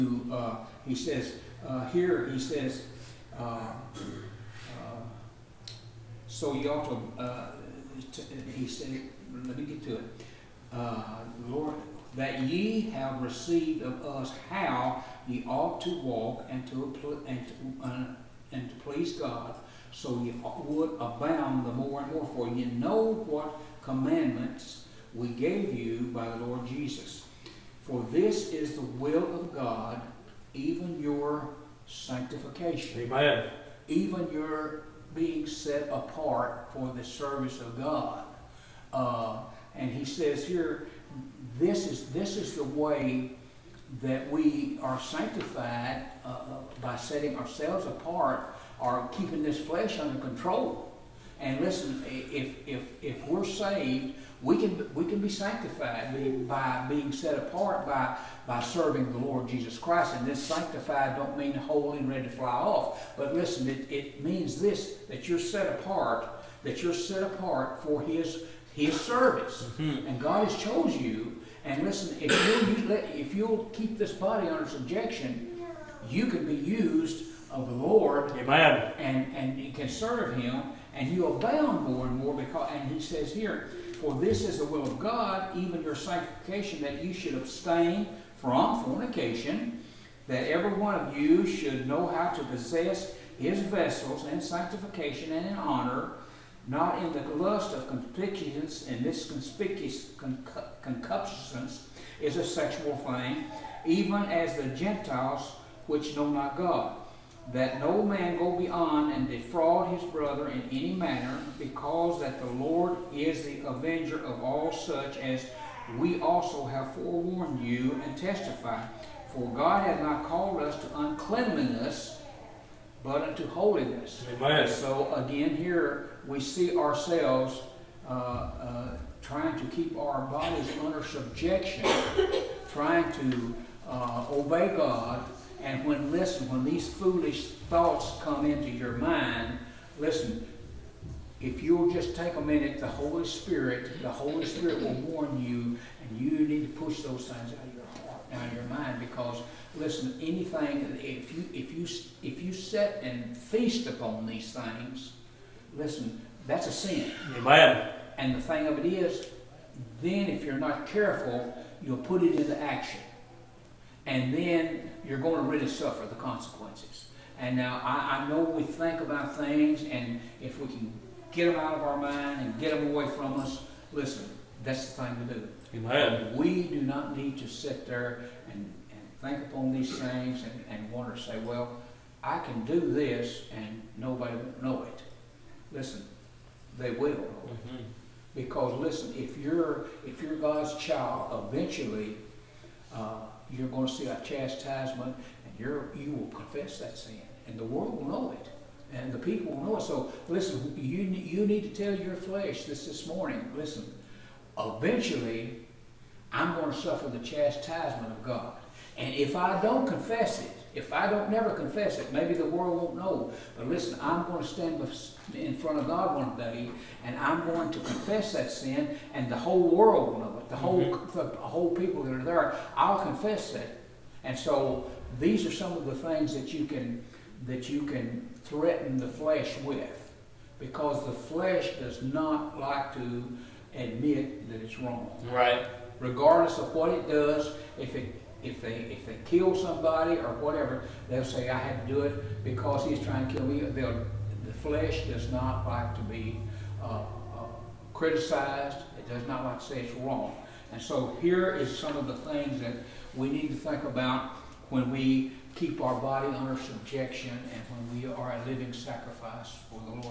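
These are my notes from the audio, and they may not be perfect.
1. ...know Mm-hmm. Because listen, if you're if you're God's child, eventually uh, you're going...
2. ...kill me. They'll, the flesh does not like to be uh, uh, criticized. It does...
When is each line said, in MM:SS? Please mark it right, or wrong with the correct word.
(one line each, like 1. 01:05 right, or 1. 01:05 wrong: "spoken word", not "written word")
1. 03:07 right
2. 04:03 right.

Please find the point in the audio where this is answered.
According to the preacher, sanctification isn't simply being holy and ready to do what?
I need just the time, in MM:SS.
01:02.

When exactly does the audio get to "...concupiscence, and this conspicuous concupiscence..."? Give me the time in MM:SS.
01:37.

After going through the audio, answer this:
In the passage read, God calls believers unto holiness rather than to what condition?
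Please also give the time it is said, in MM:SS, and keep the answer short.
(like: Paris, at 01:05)
uncleanliness, at 02:00.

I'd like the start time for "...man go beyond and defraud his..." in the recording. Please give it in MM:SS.
01:48.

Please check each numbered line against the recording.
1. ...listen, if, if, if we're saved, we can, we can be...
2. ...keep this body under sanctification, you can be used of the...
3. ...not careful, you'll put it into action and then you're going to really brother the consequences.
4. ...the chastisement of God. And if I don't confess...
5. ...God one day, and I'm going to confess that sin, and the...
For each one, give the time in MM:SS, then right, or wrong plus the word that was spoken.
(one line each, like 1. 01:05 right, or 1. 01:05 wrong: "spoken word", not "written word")
1. 00:51 right
2. 01:13 wrong: "subjection", not "sanctification"
3. 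02:40 wrong: "suffer", not "brother"
4. 03:27 right
5. 03:35 right.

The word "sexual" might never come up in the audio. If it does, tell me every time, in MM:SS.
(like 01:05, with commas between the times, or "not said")
01:42.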